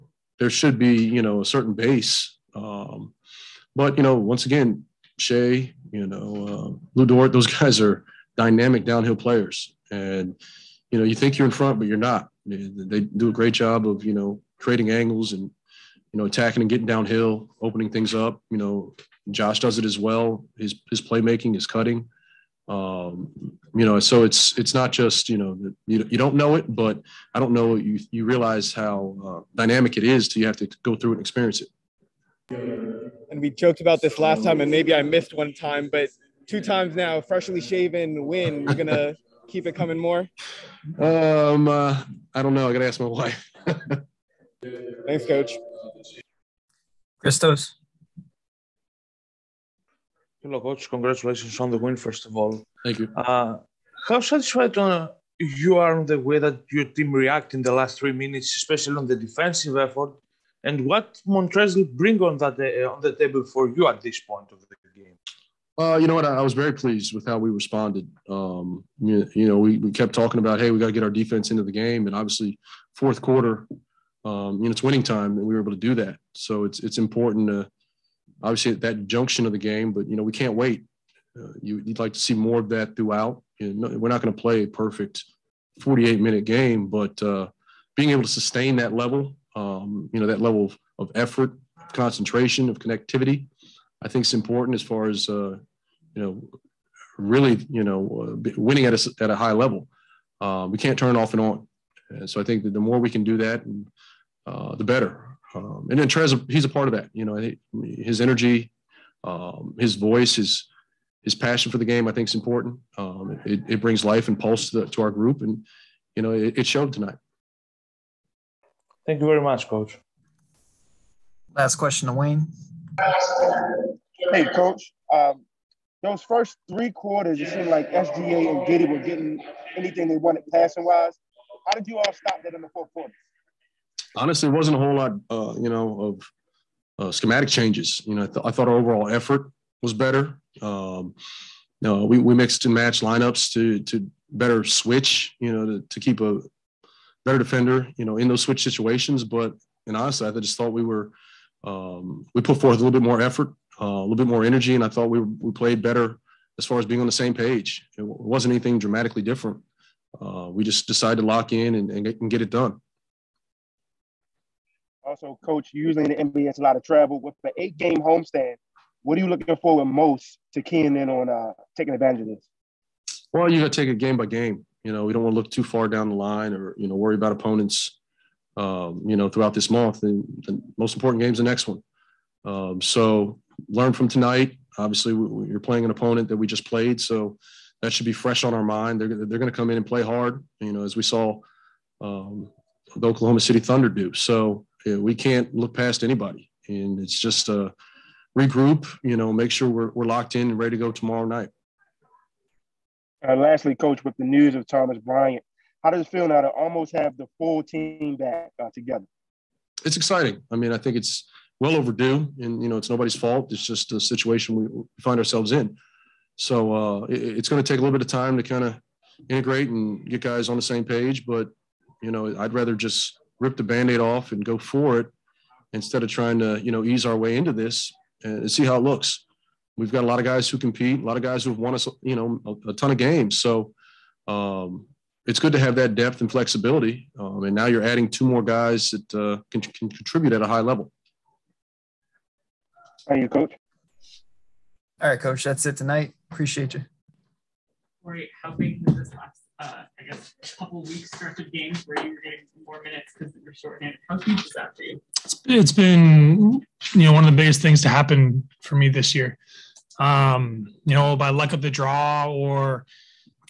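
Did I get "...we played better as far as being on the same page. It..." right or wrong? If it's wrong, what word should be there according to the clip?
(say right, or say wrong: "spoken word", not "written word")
right.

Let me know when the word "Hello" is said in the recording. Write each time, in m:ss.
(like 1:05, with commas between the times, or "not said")
0:50.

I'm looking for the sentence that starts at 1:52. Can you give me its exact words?
Um, it, it, brings life and pulse to, the, to our group, and you know, it, it showed tonight.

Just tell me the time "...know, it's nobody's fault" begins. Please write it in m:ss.
3:32.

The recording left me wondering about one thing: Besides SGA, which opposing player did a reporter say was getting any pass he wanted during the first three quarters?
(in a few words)
Giddey.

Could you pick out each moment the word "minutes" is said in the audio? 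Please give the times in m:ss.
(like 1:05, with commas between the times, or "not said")
0:58, 1:26, 4:12.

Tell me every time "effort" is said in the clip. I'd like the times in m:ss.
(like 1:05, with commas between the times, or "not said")
0:59, 1:31, 2:19, 2:33.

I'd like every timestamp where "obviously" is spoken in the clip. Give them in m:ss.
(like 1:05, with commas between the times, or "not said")
1:12, 1:18, 3:04.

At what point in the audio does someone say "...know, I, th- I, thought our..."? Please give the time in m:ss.
2:18.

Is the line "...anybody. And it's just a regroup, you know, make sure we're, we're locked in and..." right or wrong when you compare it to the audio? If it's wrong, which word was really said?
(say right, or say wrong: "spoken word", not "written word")
right.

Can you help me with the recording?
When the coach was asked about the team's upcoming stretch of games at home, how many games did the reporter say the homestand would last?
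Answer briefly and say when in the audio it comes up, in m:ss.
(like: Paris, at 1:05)
8, at 2:47.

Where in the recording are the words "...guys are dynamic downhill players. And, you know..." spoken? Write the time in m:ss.
0:07.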